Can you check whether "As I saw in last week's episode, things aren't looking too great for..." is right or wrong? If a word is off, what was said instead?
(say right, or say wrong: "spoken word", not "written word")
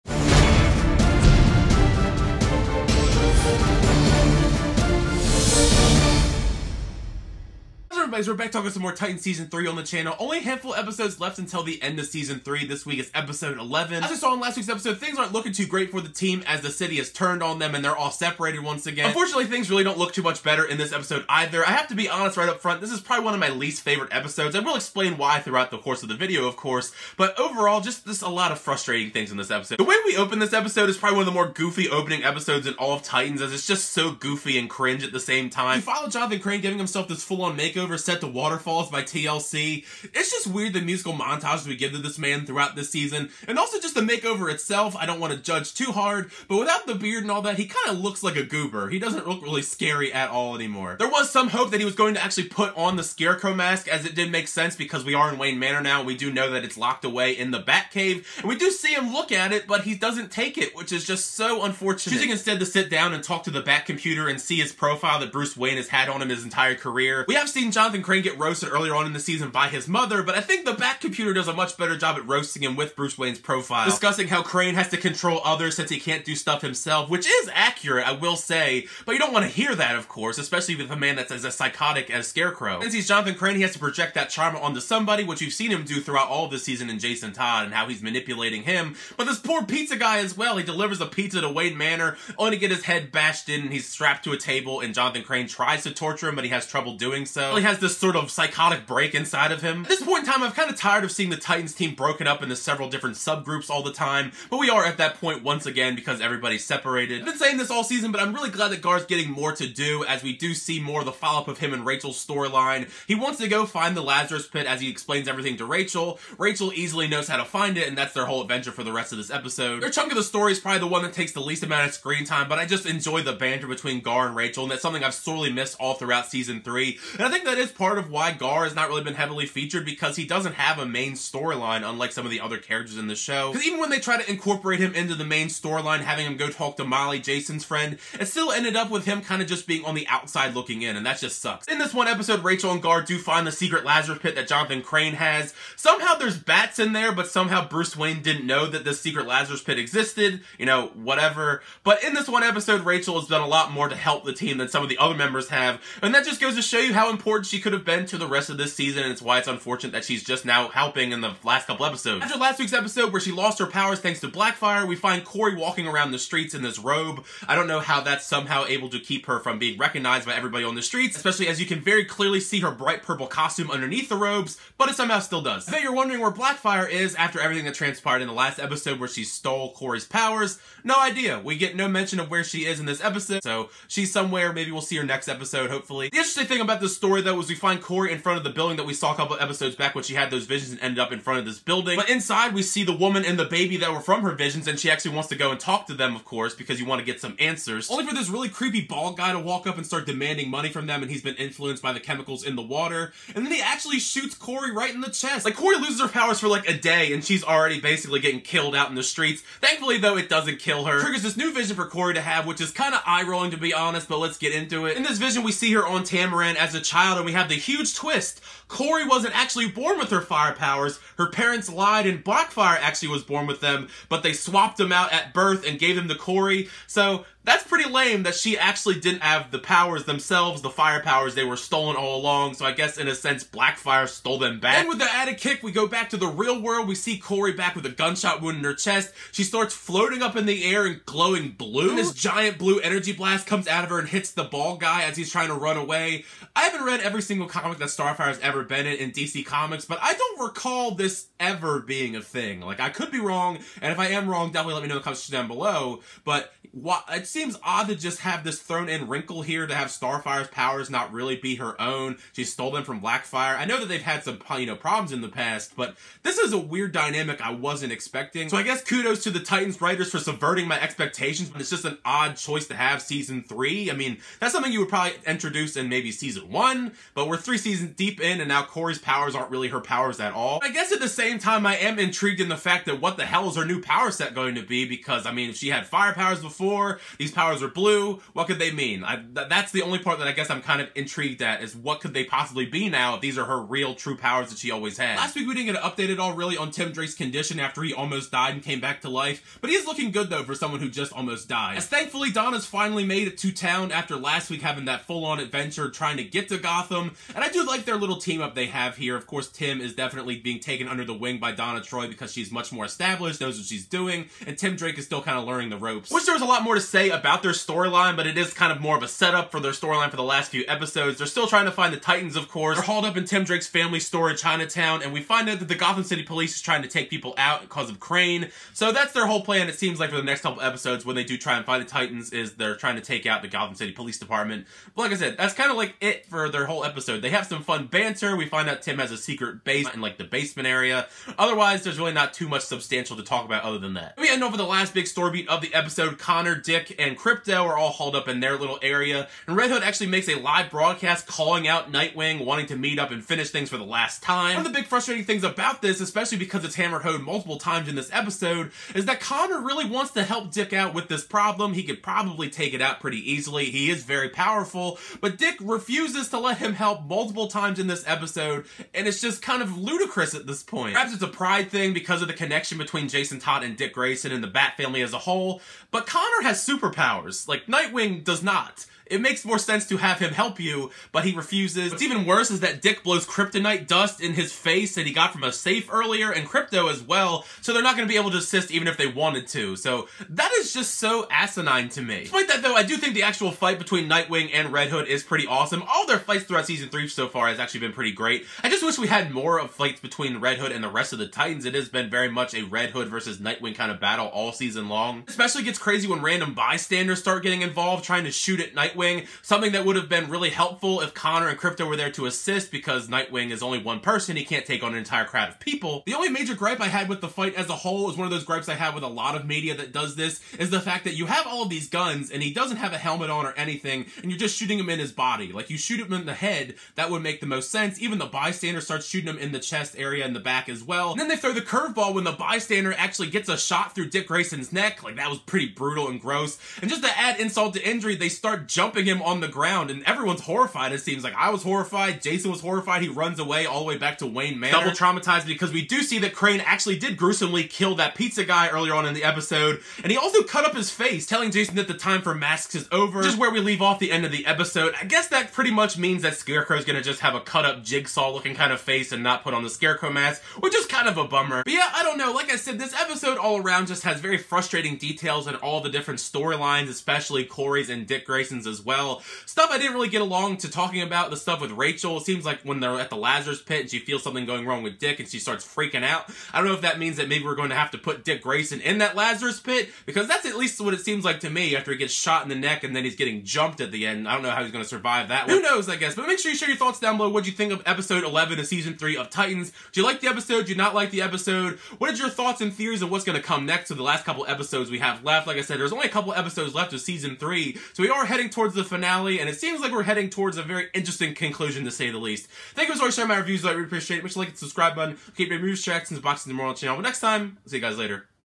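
right.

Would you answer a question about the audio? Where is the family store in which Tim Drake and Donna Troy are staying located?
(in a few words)
Chinatown.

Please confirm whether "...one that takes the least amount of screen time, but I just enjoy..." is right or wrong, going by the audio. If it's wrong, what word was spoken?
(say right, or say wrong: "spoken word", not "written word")
right.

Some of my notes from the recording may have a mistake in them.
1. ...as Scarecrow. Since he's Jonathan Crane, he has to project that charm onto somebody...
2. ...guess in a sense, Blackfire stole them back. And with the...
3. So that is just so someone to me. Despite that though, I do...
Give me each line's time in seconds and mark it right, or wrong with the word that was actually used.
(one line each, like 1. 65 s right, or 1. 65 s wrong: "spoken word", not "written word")
1. 82 s right
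2. 232 s right
3. 389 s wrong: "asinine", not "someone".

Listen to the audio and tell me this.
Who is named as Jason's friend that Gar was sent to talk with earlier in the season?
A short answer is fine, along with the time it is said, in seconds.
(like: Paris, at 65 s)
Molly, at 136 s.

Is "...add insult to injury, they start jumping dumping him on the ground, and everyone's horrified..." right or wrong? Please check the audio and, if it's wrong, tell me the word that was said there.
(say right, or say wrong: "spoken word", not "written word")
right.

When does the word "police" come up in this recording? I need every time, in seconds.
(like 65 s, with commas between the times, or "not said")
326 s, 333 s.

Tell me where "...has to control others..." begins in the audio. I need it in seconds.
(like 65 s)
74 s.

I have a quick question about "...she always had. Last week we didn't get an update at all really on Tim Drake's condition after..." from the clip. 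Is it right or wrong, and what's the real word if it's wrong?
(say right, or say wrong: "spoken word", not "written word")
right.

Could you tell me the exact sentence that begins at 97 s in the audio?
He has this sort of psychotic break inside of him.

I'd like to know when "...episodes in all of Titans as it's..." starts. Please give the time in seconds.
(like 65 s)
32 s.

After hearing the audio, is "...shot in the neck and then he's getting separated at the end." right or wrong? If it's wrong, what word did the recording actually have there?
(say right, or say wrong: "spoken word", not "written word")
wrong: "jumped", not "separated".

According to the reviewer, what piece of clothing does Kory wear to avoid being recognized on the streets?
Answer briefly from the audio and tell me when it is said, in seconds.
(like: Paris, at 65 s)
robe, at 166 s.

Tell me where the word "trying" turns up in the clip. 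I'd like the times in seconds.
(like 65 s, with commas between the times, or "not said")
245 s, 305 s, 321 s, 326 s, 332 s, 408 s.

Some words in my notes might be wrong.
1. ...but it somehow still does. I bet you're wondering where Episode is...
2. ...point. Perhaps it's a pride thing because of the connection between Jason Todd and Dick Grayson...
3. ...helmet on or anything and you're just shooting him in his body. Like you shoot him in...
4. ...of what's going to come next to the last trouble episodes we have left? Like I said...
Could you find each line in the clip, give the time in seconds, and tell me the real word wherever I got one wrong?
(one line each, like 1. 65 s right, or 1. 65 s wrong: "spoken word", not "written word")
1. 174 s wrong: "Blackfire", not "Episode"
2. 370 s right
3. 422 s right
4. 493 s wrong: "couple", not "trouble".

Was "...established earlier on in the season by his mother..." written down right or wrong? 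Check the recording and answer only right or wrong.
wrong.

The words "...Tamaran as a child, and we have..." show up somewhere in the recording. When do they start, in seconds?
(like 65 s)
216 s.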